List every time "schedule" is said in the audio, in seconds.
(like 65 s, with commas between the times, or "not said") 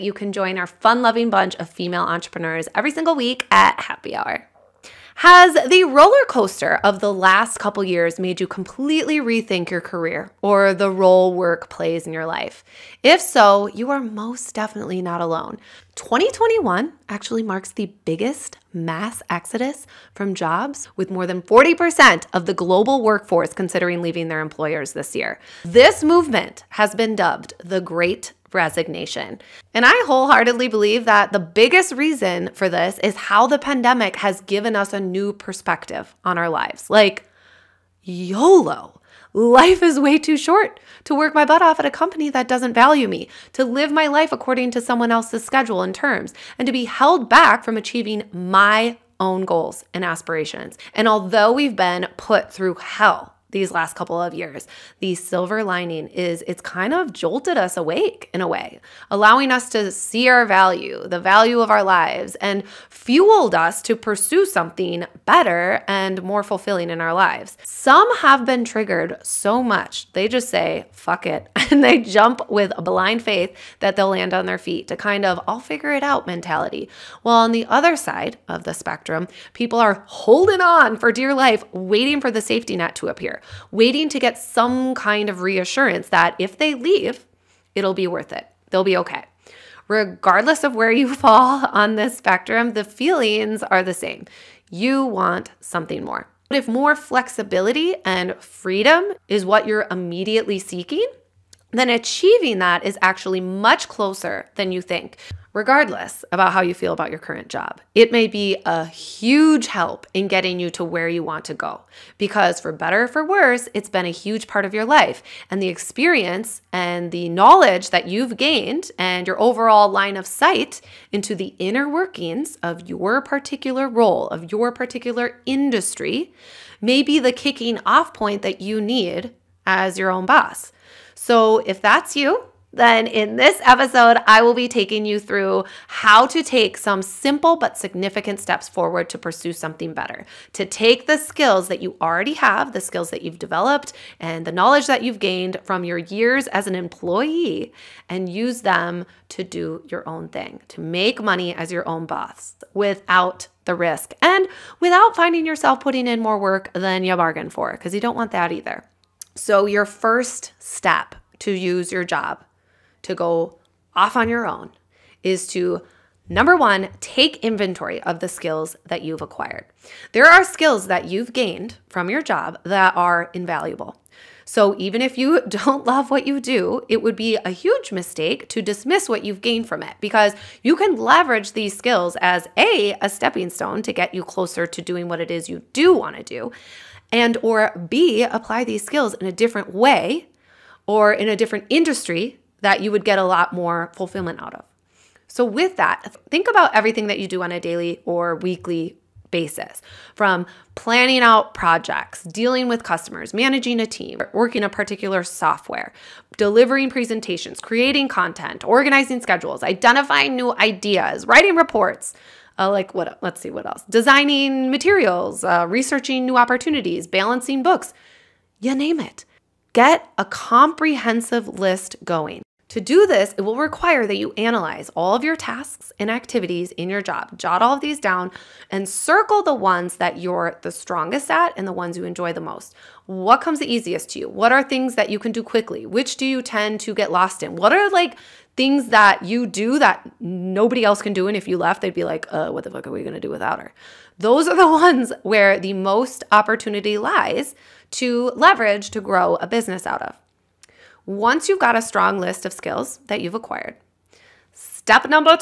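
45 s, 209 s.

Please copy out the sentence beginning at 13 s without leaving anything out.
If so, you are most definitely not alone.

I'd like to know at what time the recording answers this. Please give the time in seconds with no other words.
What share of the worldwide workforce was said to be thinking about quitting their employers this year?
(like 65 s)
21 s.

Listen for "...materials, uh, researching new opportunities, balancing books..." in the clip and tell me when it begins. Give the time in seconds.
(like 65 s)
214 s.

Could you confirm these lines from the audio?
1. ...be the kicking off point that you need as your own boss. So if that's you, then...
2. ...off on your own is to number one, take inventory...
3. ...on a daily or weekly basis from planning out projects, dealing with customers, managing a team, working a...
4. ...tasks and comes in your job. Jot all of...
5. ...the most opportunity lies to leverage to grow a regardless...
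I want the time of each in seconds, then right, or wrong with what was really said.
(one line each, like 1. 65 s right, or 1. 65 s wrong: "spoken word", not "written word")
1. 127 s right
2. 163 s right
3. 197 s right
4. 225 s wrong: "activities", not "comes"
5. 245 s wrong: "business", not "regardless".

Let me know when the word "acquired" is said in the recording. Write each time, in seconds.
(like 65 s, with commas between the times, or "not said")
169 s, 253 s.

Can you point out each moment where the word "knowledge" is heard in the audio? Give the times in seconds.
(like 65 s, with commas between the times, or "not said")
117 s, 144 s.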